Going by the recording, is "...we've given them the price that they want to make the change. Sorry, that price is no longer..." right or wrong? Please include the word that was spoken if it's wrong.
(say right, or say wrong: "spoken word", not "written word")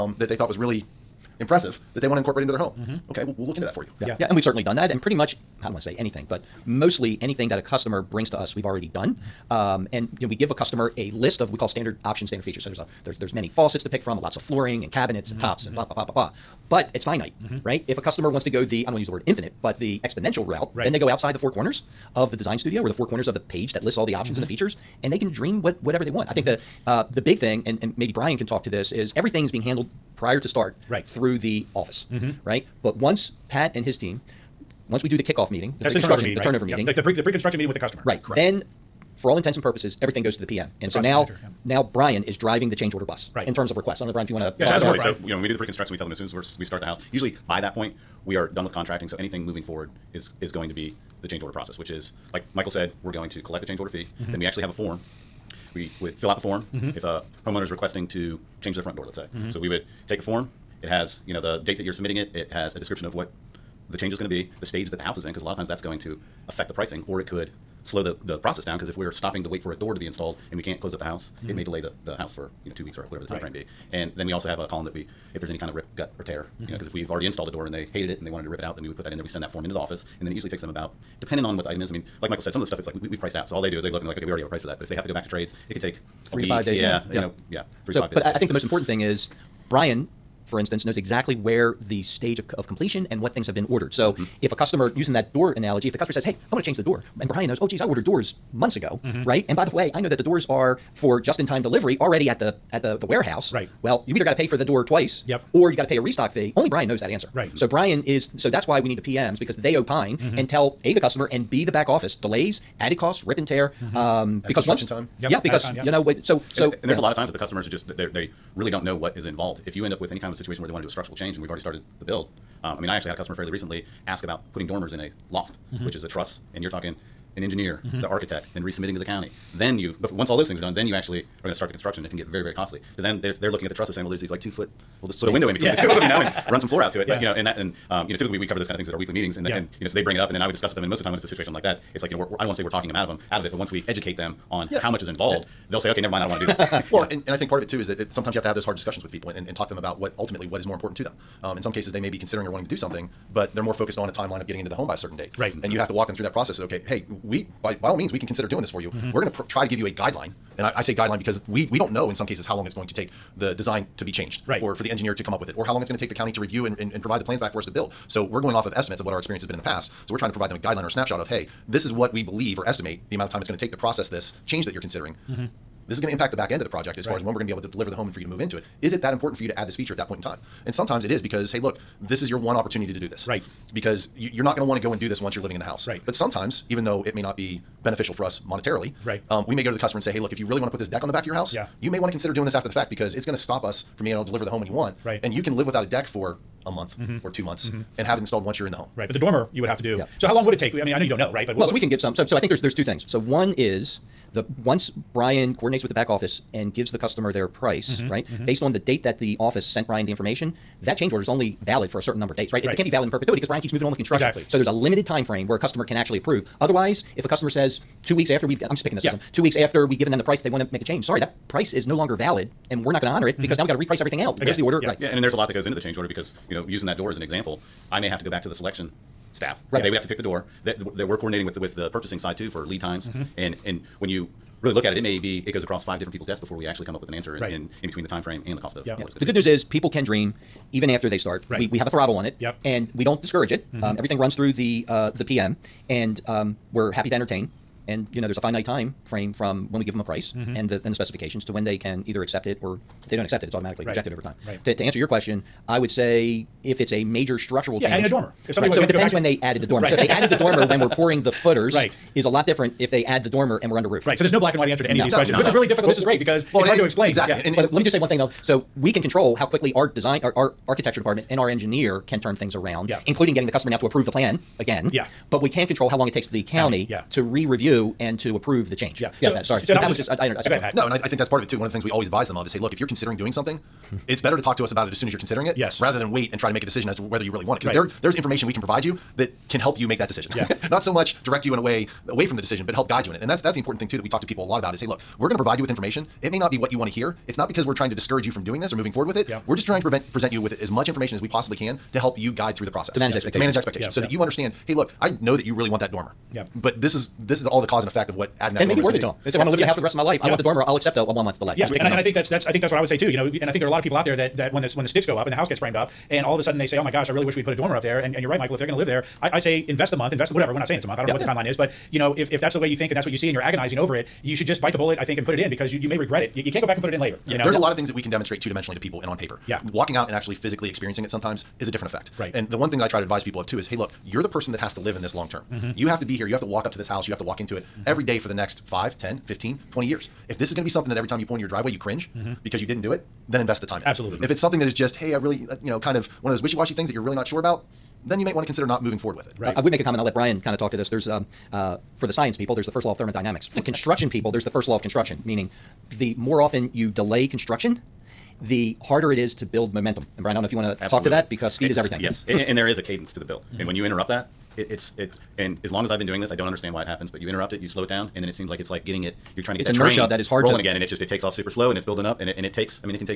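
right.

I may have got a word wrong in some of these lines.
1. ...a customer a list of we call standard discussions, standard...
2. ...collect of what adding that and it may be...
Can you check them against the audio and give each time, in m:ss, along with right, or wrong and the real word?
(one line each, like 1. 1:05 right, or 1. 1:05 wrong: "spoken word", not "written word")
1. 0:10 wrong: "options", not "discussions"
2. 5:07 wrong: "effect", not "collect".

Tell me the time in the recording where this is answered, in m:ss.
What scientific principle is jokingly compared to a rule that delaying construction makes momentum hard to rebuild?
5:52.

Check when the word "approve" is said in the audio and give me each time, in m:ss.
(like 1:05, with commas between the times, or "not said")
3:36, 4:33, 4:38.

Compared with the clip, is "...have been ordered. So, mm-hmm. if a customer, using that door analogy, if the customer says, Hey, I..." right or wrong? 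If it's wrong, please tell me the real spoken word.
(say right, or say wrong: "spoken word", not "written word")
right.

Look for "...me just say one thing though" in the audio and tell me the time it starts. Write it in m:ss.
4:27.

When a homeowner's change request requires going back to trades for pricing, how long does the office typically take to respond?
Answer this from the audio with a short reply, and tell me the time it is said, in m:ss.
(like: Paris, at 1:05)
3 to 5 days, at 1:26.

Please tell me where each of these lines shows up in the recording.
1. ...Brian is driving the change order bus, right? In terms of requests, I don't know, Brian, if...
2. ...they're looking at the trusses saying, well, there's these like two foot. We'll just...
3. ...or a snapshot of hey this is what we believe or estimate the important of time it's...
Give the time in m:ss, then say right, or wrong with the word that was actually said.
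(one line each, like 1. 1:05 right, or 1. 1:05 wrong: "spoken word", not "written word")
1. 0:41 right
2. 2:13 right
3. 2:50 wrong: "amount", not "important".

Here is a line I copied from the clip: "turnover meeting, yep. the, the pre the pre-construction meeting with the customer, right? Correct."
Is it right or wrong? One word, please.
right.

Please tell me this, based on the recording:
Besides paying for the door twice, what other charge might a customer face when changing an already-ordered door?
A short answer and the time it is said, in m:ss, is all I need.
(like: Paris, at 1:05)
Restock fee, at 1:45.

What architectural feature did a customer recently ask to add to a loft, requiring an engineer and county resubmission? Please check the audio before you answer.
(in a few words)
Dormers.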